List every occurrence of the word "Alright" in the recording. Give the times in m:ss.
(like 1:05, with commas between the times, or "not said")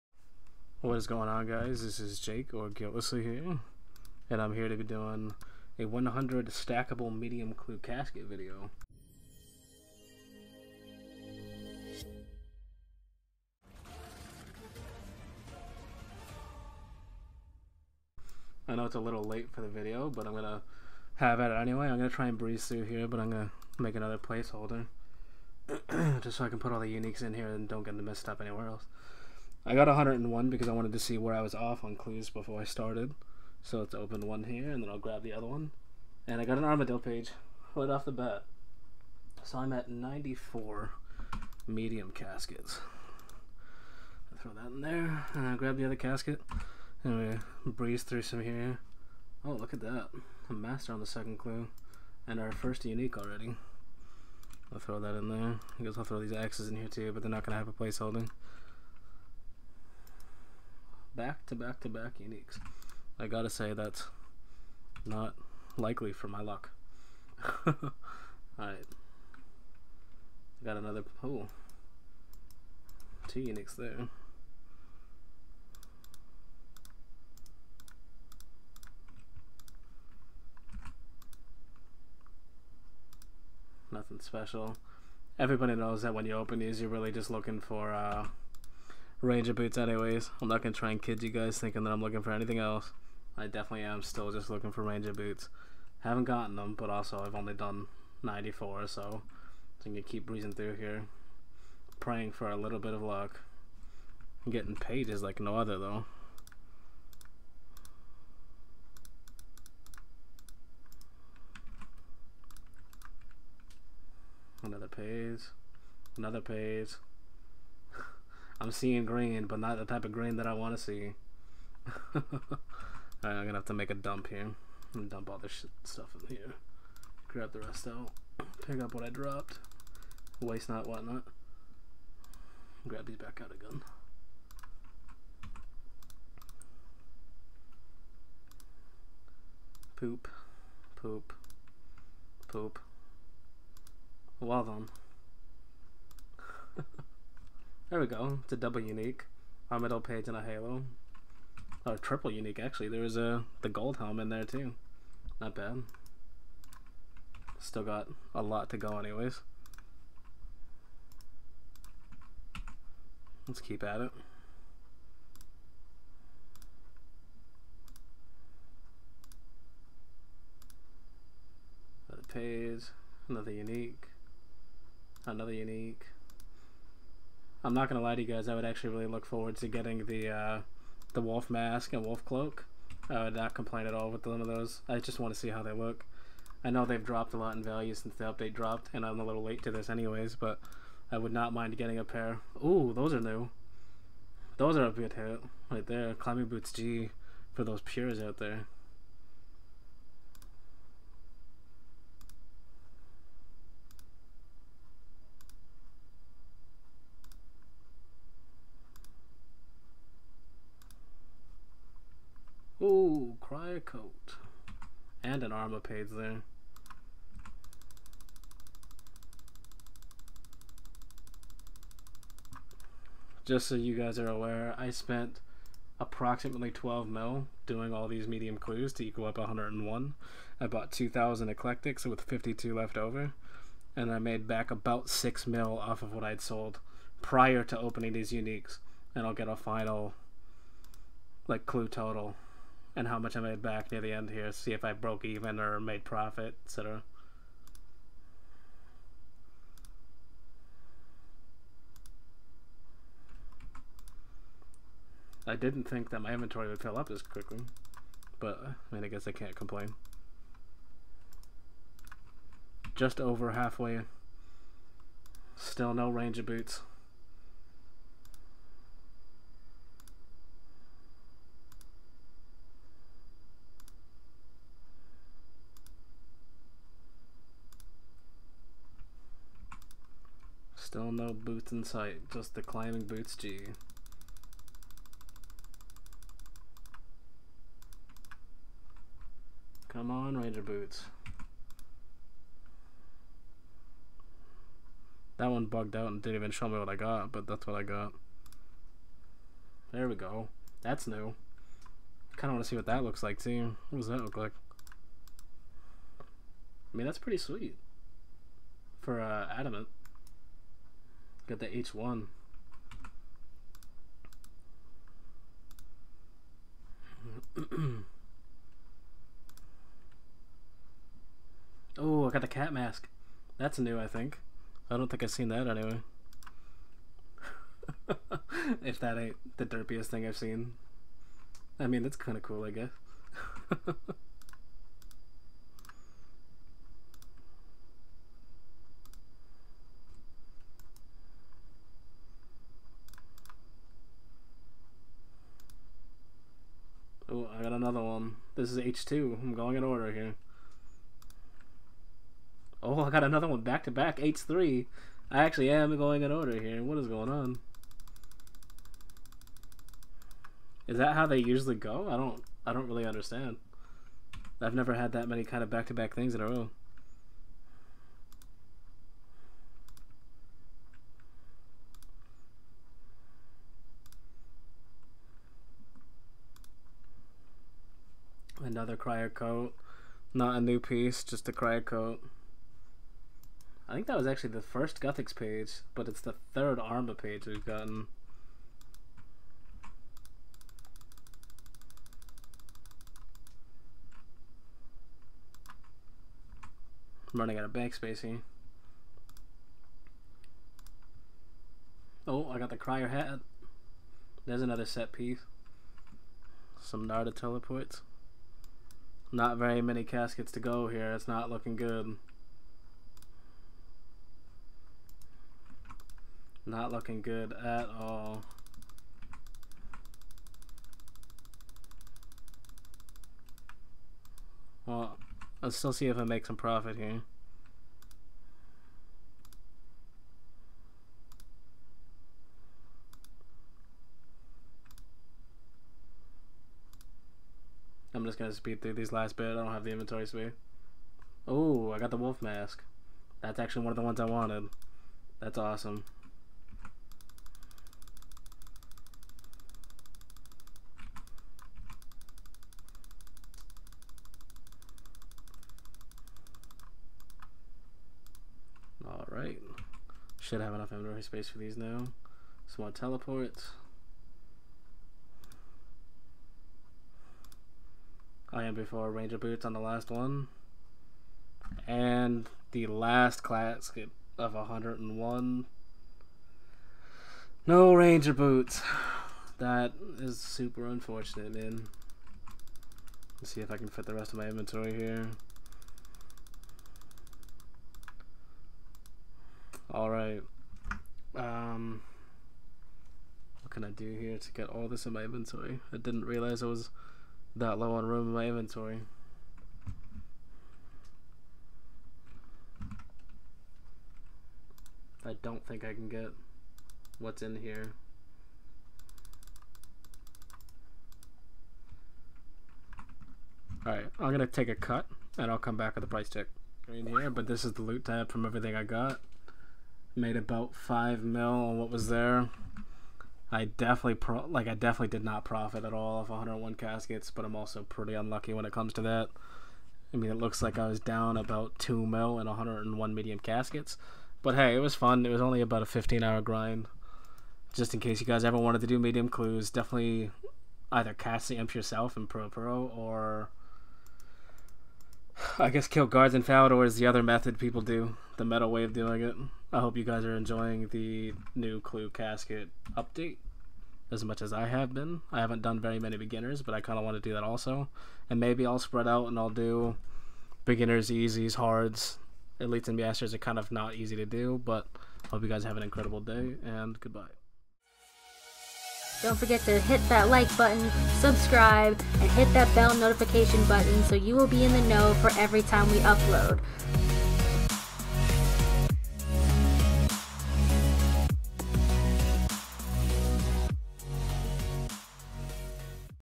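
1:07, 7:39, 8:09, 8:33.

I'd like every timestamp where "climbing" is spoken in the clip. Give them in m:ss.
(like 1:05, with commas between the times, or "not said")
3:16, 4:42.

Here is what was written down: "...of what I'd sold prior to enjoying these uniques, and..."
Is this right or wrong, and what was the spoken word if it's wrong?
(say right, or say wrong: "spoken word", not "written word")
wrong: "opening", not "enjoying".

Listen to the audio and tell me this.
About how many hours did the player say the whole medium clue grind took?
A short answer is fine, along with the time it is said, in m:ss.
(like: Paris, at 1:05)
15, at 8:55.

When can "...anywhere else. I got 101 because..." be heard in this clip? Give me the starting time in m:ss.
0:28.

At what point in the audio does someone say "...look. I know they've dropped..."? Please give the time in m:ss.
3:05.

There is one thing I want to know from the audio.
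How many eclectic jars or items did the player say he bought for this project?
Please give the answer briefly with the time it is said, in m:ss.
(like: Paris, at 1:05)
2,000, at 3:50.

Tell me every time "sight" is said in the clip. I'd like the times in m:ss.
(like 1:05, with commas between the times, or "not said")
4:41.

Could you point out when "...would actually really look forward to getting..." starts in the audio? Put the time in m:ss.
2:58.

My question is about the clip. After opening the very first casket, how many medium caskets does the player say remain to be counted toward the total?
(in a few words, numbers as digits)
94.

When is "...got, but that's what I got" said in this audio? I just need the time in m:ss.
4:56.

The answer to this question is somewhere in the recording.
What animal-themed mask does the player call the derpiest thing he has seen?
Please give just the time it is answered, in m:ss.
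5:22.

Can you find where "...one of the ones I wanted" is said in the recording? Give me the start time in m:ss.
7:23.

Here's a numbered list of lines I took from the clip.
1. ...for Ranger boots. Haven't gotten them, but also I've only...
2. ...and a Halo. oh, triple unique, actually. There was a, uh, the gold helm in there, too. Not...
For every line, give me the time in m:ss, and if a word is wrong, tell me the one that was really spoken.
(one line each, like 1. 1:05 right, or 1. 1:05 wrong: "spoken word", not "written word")
1. 1:34 right
2. 2:30 right.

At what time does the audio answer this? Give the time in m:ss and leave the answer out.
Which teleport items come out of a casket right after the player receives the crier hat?
6:47.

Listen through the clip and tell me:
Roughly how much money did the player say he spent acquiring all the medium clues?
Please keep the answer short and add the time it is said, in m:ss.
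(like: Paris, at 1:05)
12 mil, at 3:46.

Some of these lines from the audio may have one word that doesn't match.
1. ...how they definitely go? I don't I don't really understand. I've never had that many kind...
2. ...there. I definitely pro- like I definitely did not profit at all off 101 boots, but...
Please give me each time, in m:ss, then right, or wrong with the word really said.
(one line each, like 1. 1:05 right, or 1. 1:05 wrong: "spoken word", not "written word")
1. 6:01 wrong: "usually", not "definitely"
2. 8:42 wrong: "caskets", not "boots".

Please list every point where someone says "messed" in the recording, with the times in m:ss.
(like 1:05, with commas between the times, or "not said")
0:28.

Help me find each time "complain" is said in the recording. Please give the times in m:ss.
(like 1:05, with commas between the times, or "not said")
3:03, 4:19.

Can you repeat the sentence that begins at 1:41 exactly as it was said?
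Praying for a little bit of luck.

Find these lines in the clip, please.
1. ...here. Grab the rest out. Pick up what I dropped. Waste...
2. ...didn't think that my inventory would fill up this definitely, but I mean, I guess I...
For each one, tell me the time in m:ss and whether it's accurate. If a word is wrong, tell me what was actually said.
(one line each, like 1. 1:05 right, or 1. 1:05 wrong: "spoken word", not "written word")
1. 2:06 right
2. 4:15 wrong: "quickly", not "definitely".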